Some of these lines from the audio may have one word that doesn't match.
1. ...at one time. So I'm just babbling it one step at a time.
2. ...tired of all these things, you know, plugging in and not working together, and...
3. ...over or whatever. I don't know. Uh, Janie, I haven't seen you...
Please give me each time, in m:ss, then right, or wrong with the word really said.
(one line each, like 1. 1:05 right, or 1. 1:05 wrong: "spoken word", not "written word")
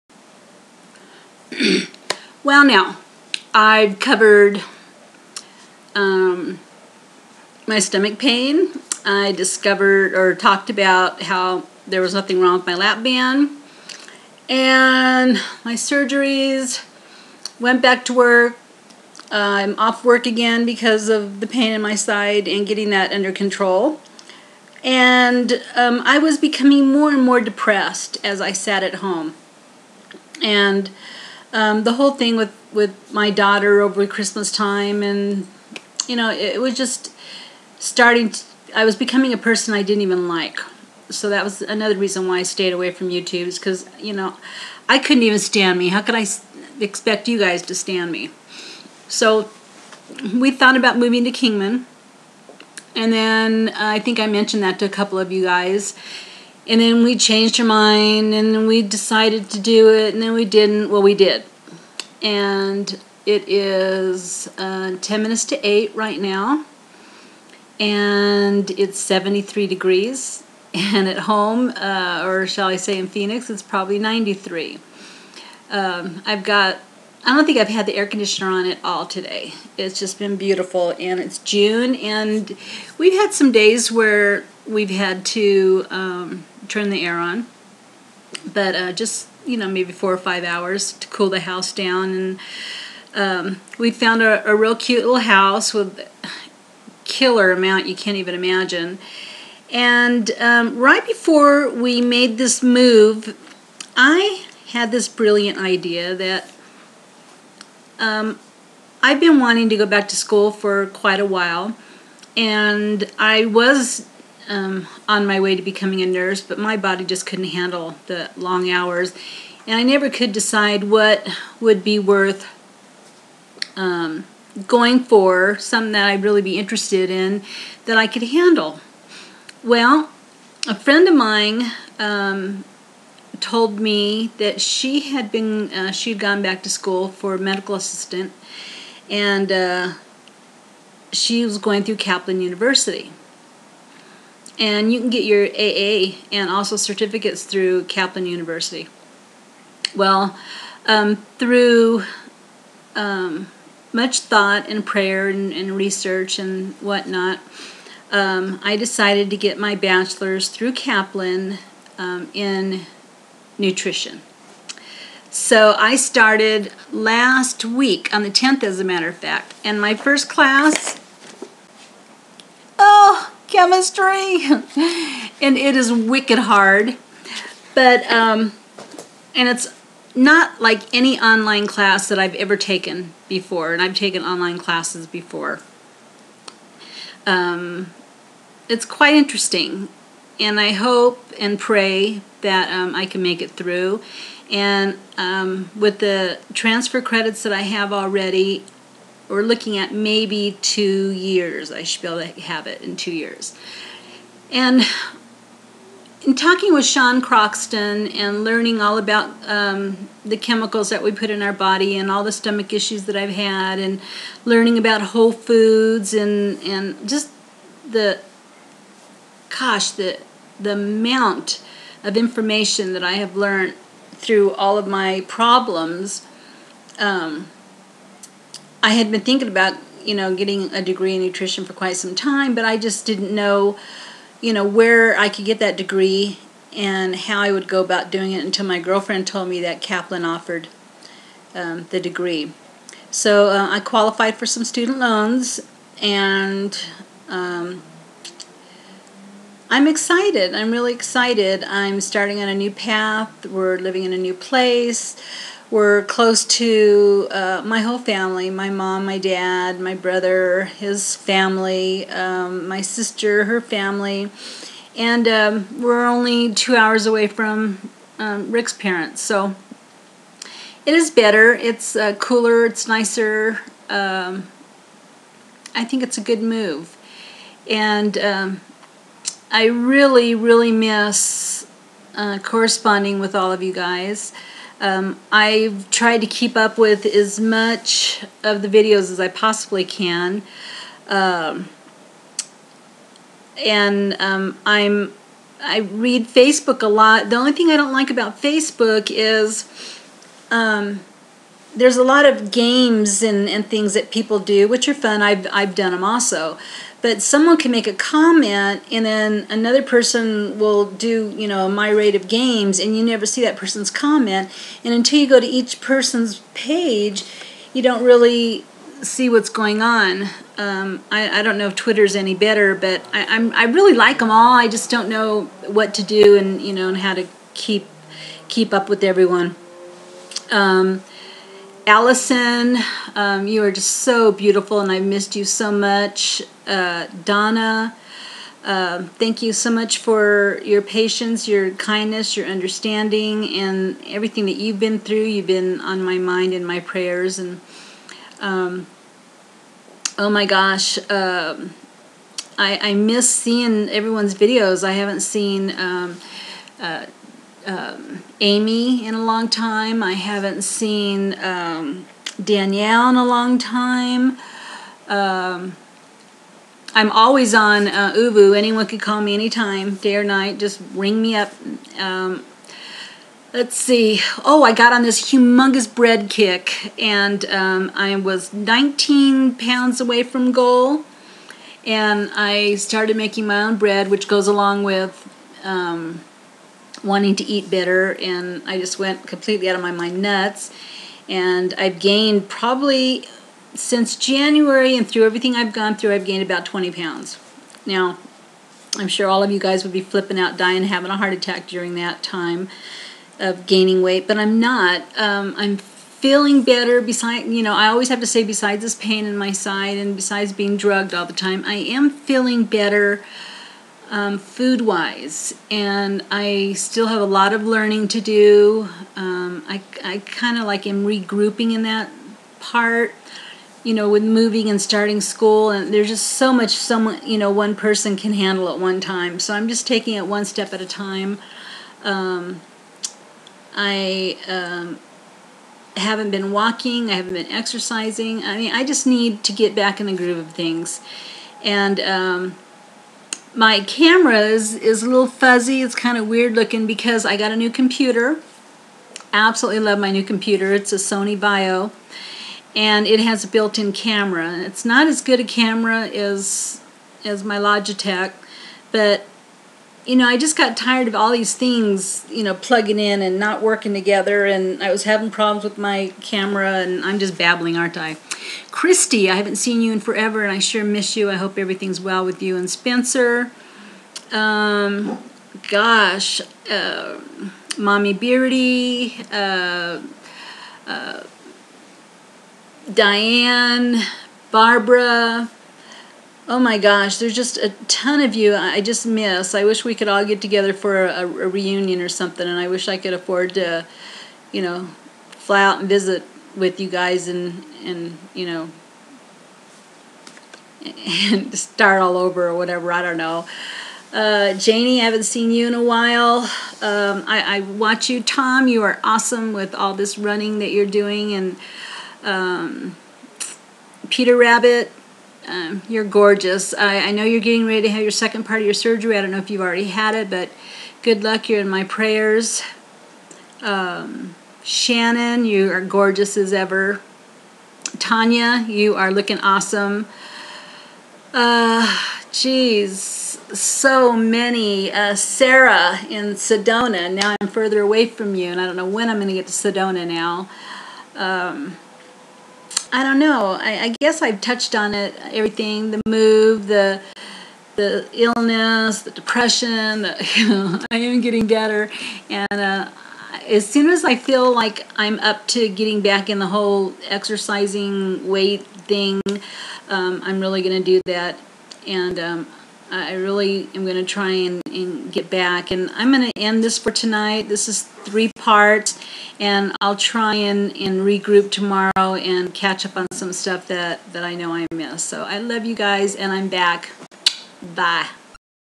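1. 7:08 wrong: "taking", not "babbling"
2. 7:40 right
3. 8:22 right.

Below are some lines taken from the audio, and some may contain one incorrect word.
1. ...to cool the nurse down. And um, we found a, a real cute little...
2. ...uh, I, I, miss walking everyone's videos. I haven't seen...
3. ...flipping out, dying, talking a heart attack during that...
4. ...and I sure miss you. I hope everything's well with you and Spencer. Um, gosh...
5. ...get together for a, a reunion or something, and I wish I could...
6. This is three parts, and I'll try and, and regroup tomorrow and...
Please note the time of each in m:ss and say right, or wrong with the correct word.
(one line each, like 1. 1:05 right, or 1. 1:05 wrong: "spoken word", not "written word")
1. 1:30 wrong: "house", not "nurse"
2. 5:51 wrong: "seeing", not "walking"
3. 6:40 wrong: "having", not "talking"
4. 7:50 right
5. 8:10 right
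6. 9:27 right.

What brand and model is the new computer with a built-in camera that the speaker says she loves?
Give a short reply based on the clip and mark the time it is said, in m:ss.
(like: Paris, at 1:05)
Sony VAIO, at 7:30.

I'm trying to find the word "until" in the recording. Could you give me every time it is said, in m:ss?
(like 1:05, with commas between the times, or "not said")
3:58, 5:14.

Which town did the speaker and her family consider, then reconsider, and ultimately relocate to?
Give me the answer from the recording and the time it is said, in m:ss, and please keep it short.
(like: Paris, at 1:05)
Kingman, at 0:51.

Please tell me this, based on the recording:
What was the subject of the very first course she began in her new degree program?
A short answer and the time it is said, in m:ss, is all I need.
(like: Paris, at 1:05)
chemistry, at 2:53.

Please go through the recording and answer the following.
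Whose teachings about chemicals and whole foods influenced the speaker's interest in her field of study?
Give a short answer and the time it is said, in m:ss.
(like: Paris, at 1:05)
Sean Croxton, at 3:26.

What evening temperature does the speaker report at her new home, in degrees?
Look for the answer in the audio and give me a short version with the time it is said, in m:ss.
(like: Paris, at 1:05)
73, at 1:08.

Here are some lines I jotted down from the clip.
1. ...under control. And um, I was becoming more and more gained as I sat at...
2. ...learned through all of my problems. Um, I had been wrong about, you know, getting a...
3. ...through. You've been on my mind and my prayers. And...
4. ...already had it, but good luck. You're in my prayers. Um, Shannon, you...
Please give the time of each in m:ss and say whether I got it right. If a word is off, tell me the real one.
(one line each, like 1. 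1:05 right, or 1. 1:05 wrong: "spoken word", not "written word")
1. 0:23 wrong: "depressed", not "gained"
2. 3:43 wrong: "thinking", not "wrong"
3. 5:44 right
4. 8:39 right.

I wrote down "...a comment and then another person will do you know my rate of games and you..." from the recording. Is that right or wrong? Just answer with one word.
right.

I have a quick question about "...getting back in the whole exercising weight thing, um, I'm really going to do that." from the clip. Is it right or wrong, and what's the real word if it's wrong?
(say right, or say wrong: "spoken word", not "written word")
right.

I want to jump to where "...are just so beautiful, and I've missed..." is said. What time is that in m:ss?
5:33.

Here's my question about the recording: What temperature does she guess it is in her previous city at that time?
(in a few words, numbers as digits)
93.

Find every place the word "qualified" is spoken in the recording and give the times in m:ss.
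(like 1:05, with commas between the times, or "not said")
4:03.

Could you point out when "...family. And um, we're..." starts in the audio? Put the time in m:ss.
4:23.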